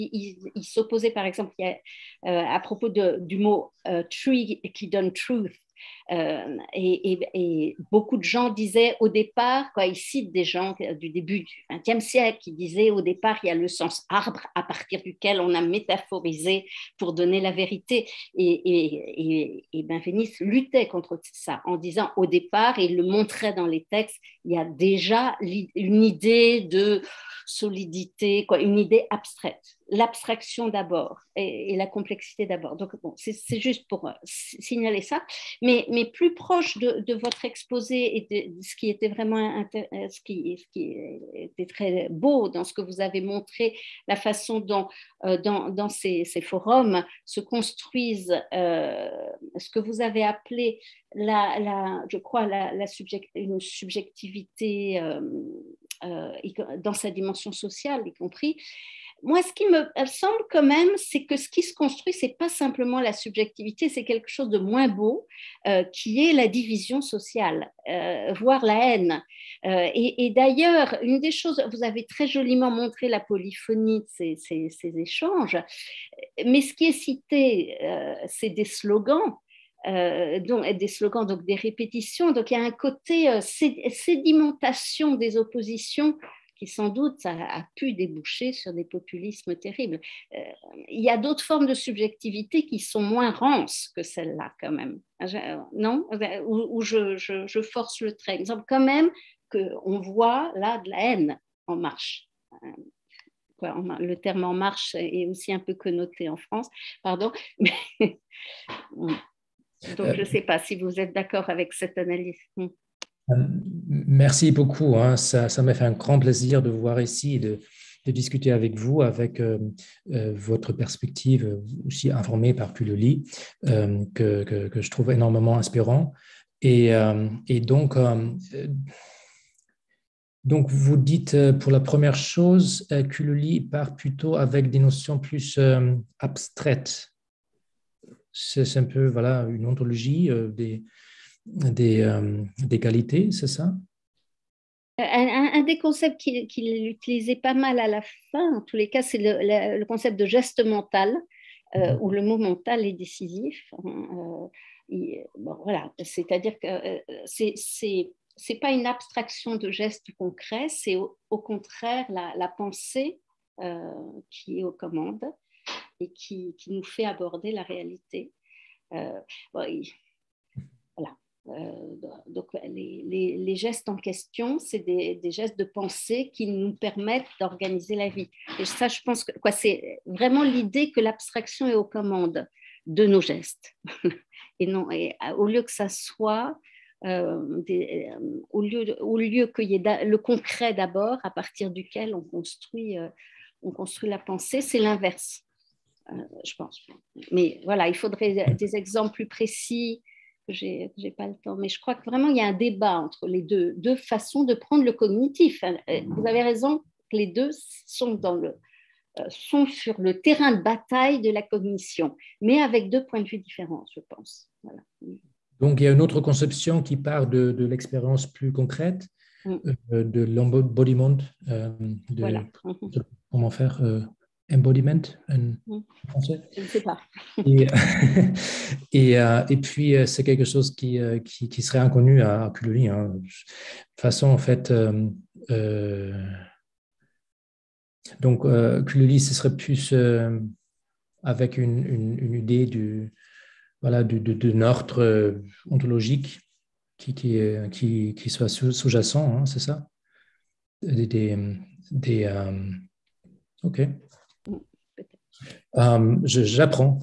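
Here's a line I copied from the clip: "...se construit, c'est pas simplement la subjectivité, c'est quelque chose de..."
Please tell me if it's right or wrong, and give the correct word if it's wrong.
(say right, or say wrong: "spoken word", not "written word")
right.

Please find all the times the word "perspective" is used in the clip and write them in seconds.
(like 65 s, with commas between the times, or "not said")
120 s.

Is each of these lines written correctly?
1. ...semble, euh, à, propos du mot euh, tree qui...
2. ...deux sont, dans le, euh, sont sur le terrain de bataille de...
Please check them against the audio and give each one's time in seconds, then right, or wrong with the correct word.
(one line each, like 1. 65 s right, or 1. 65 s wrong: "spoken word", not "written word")
1. 1 s wrong: "exemple", not "semble"
2. 207 s right.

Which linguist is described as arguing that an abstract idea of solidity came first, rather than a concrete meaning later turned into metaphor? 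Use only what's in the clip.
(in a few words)
Benveniste.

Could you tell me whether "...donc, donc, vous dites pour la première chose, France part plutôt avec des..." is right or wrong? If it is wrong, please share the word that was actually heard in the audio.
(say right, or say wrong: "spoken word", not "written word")
wrong: "Kuloli", not "France".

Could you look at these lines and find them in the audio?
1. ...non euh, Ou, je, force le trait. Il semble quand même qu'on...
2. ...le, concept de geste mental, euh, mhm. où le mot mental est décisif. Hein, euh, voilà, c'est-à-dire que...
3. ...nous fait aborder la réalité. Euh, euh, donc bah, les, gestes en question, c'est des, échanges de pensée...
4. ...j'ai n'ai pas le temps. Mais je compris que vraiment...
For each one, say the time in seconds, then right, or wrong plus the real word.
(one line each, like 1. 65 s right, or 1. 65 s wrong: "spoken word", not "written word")
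1. 95 s right
2. 149 s right
3. 166 s wrong: "gestes", not "échanges"
4. 200 s wrong: "crois", not "compris".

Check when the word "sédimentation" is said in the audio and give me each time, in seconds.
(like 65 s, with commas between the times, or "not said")
83 s.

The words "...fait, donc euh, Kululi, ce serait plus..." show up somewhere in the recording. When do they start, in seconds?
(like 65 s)
234 s.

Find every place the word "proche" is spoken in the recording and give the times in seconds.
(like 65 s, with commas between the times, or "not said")
36 s.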